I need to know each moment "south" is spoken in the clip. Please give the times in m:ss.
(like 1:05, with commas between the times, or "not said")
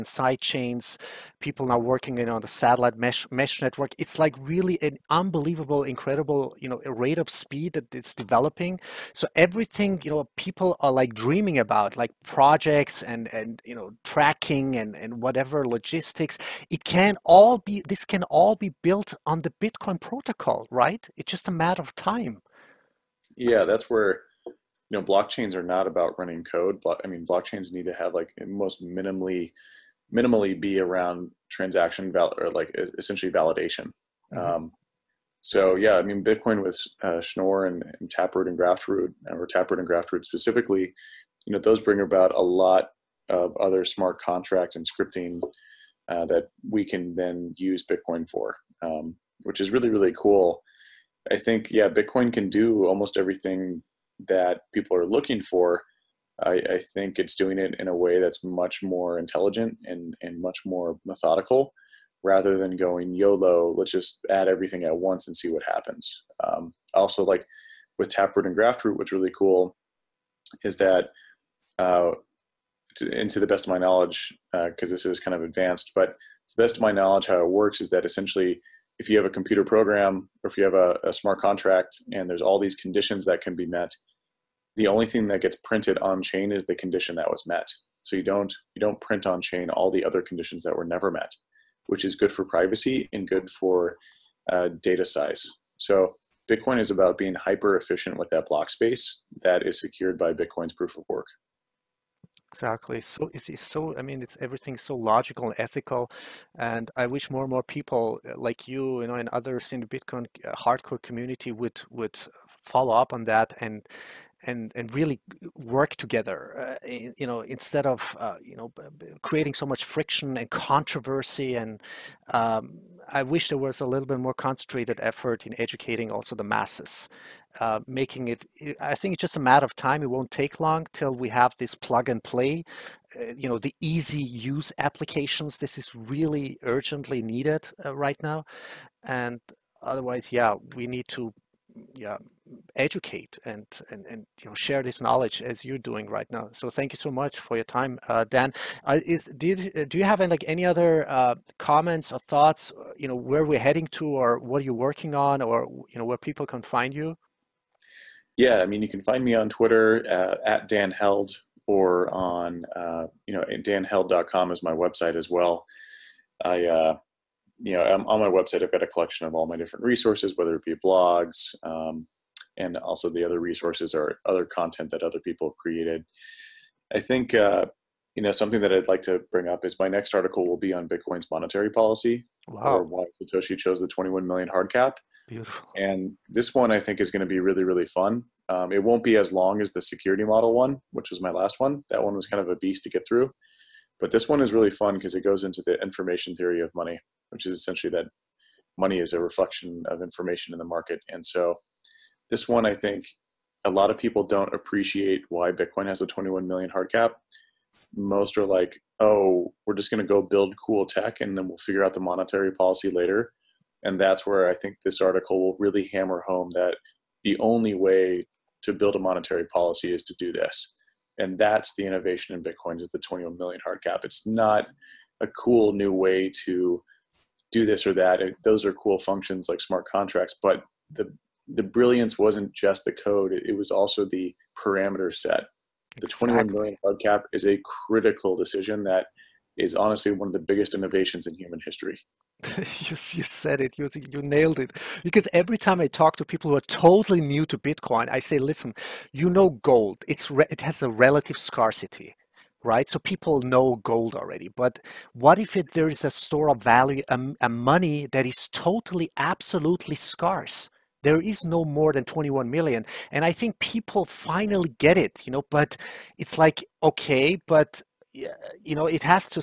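not said.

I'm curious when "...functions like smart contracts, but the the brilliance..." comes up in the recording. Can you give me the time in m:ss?
3:48.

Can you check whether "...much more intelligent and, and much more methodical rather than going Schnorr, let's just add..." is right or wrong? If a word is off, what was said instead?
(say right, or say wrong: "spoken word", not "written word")
wrong: "YOLO", not "Schnorr".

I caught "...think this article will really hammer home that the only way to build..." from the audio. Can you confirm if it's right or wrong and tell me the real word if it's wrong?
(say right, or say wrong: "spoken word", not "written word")
right.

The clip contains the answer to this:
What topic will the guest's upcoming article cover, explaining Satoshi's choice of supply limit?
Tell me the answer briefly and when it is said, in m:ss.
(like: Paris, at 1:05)
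Bitcoin's monetary policy, at 3:00.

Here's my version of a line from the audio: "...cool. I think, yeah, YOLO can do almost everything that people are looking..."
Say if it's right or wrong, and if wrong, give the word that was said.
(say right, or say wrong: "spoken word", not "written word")
wrong: "Bitcoin", not "YOLO".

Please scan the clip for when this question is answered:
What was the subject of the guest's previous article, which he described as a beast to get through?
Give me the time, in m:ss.
3:09.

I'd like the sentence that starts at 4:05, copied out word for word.
Because every time I talk to people who are totally new to Bitcoin, I say, "Listen, you know gold.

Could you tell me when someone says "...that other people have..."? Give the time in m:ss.
2:54.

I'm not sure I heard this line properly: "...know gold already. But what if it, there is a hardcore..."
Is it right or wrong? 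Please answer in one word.
wrong.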